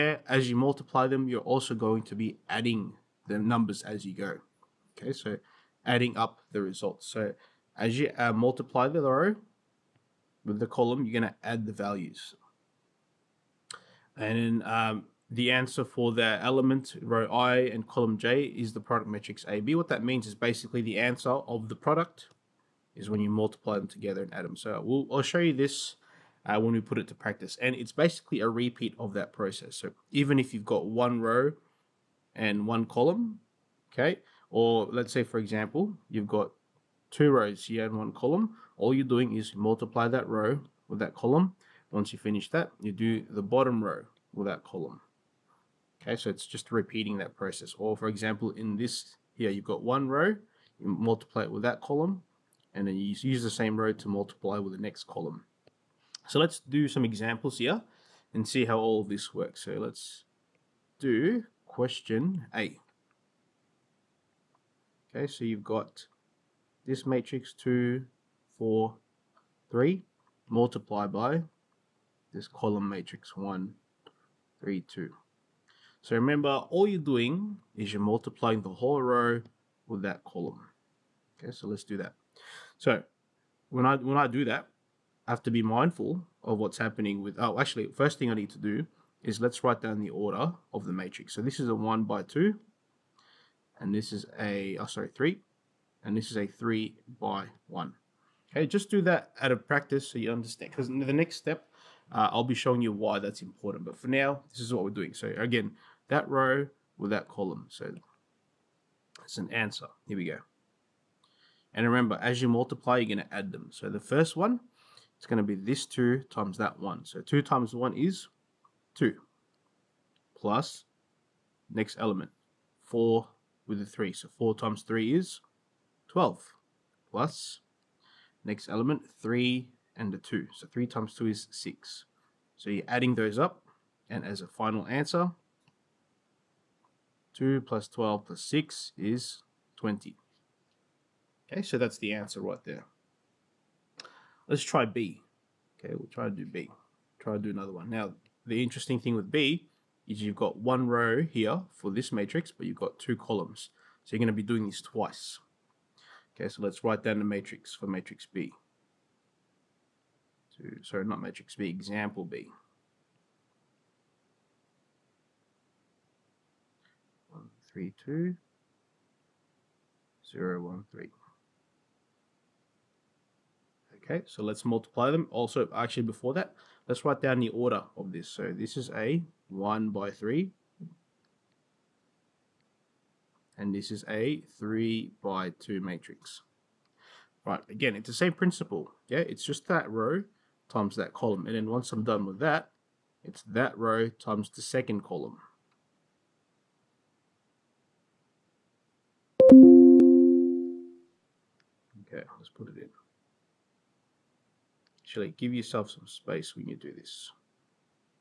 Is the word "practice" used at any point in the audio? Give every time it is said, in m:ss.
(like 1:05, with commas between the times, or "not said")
0:27, 1:39.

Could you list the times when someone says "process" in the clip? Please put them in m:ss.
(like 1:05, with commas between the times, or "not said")
0:29, 0:47.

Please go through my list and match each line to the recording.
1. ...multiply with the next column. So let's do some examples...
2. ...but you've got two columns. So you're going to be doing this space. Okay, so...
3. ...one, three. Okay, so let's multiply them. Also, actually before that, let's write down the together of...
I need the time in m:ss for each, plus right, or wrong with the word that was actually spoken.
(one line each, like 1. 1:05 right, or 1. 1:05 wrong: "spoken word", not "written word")
1. 0:54 right
2. 2:32 wrong: "twice", not "space"
3. 2:50 wrong: "order", not "together".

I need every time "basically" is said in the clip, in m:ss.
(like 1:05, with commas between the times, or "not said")
0:20, 0:27.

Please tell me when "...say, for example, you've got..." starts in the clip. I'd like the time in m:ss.
0:35.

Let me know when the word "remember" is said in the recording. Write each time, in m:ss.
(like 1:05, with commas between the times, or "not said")
1:16, 1:51.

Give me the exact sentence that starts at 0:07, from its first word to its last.
So as you uh, multiply the row with the column, you're going to add the values.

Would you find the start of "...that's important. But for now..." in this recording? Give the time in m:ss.
1:43.